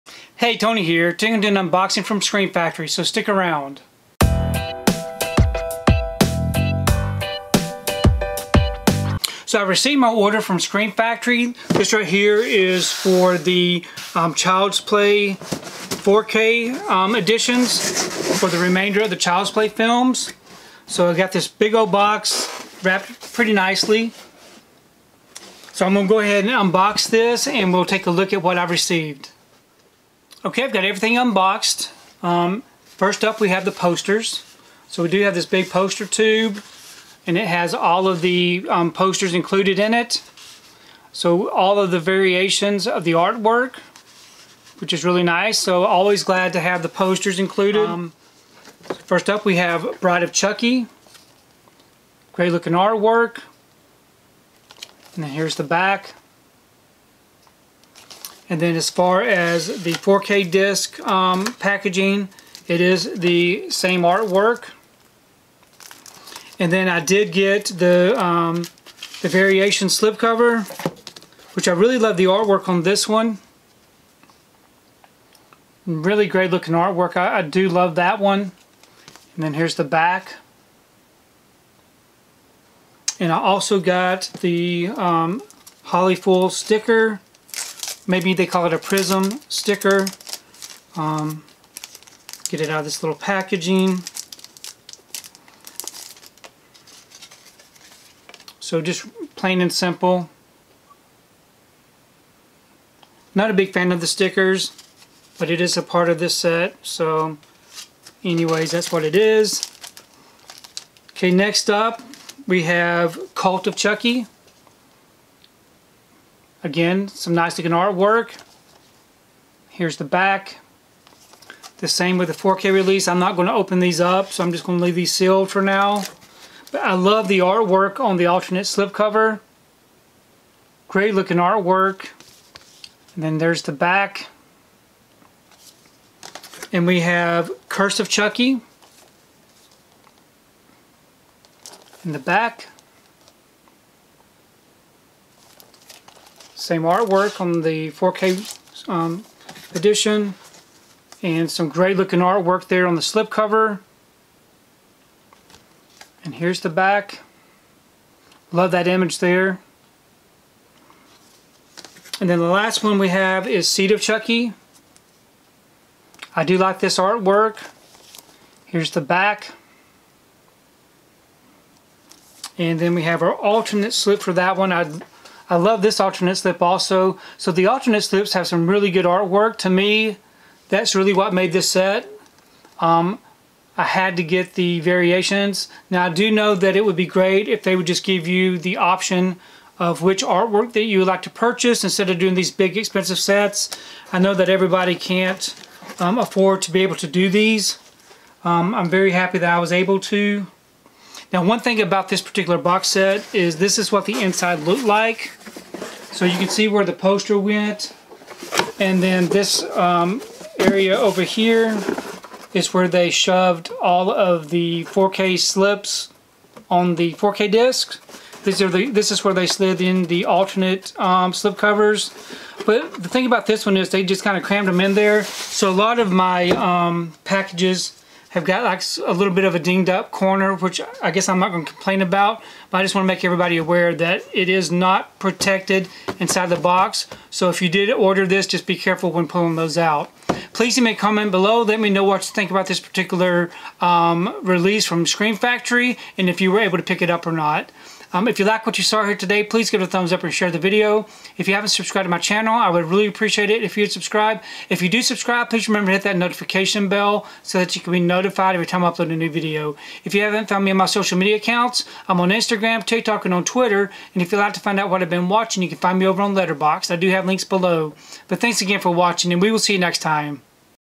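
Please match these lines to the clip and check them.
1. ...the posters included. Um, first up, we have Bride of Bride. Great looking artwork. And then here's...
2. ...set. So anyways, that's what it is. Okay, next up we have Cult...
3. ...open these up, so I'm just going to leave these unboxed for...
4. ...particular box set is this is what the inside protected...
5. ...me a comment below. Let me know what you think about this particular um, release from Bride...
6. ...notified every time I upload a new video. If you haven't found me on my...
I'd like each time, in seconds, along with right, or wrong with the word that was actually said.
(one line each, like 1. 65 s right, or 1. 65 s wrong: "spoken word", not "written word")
1. 46 s wrong: "Chucky", not "Bride"
2. 106 s right
3. 123 s wrong: "sealed", not "unboxed"
4. 202 s wrong: "looked", not "protected"
5. 240 s wrong: "Scream", not "Bride"
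6. 258 s right.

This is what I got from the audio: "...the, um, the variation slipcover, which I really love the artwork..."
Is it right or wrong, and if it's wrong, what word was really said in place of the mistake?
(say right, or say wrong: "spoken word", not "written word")
right.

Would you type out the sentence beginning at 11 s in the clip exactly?
This right here is for the um, Child's Play 4K um, editions for the remainder of the Child's Play films.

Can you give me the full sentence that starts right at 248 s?
Um, if you like what you saw here today, please give it a thumbs up and share the video.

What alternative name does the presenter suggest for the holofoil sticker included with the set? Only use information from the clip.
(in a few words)
prism sticker.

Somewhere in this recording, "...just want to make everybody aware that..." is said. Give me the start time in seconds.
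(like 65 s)
232 s.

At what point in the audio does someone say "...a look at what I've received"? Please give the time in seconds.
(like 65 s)
28 s.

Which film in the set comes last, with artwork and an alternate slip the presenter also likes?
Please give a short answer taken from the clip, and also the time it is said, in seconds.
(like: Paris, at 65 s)
Seed of Chucky, at 163 s.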